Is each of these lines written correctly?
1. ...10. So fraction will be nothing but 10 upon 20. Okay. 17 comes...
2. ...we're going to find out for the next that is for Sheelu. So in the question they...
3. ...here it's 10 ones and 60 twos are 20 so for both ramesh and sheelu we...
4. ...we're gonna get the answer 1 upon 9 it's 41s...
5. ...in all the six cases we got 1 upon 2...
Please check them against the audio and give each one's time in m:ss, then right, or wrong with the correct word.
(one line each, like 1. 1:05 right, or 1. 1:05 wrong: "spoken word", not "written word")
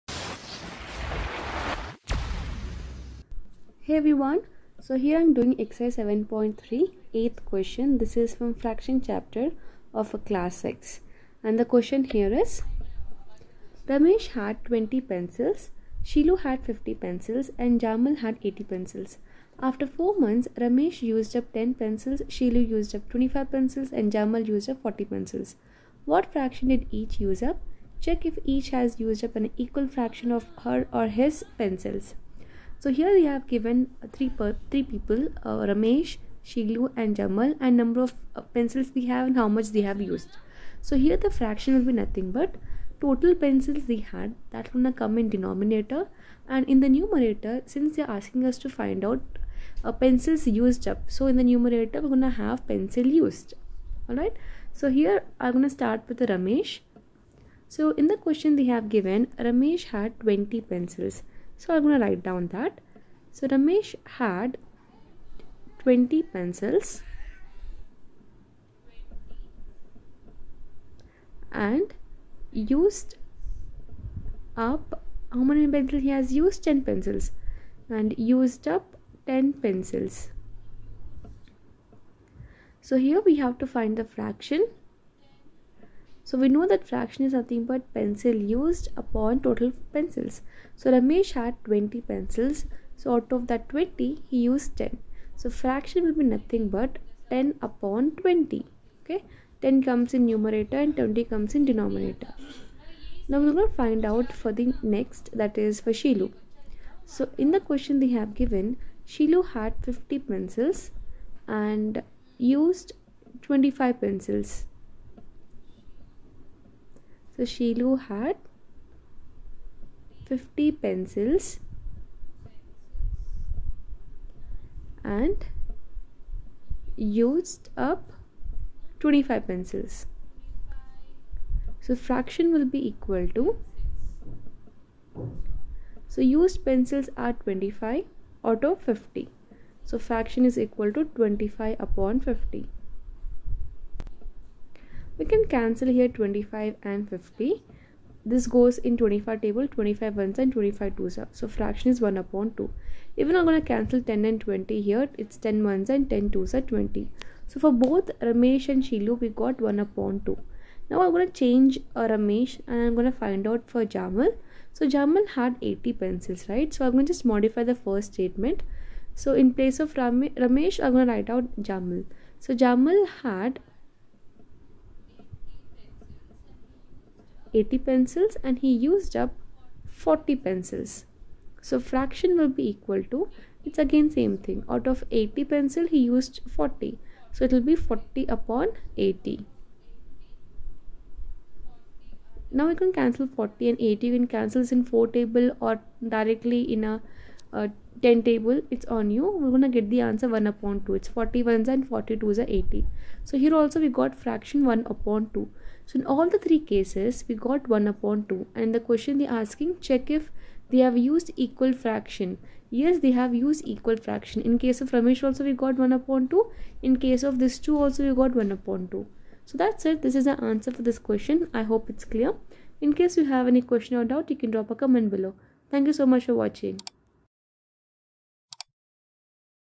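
1. 1:34 wrong: "10", not "17"
2. 1:43 right
3. 2:34 wrong: "10", not "60"
4. 3:19 wrong: "2", not "9"
5. 3:25 wrong: "three", not "six".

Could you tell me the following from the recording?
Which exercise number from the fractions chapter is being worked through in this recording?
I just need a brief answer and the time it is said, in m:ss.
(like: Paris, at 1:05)
7.3, at 0:05.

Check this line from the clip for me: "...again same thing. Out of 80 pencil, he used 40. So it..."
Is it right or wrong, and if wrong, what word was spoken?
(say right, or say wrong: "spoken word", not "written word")
right.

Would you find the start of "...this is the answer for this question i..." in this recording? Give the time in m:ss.
3:40.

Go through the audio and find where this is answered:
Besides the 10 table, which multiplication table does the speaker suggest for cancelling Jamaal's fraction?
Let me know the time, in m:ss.
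3:14.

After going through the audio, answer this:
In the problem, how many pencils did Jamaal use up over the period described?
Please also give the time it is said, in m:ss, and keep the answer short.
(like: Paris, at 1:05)
40, at 0:24.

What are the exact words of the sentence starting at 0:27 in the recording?
Check if each has used up an equal fraction of her or his pencils.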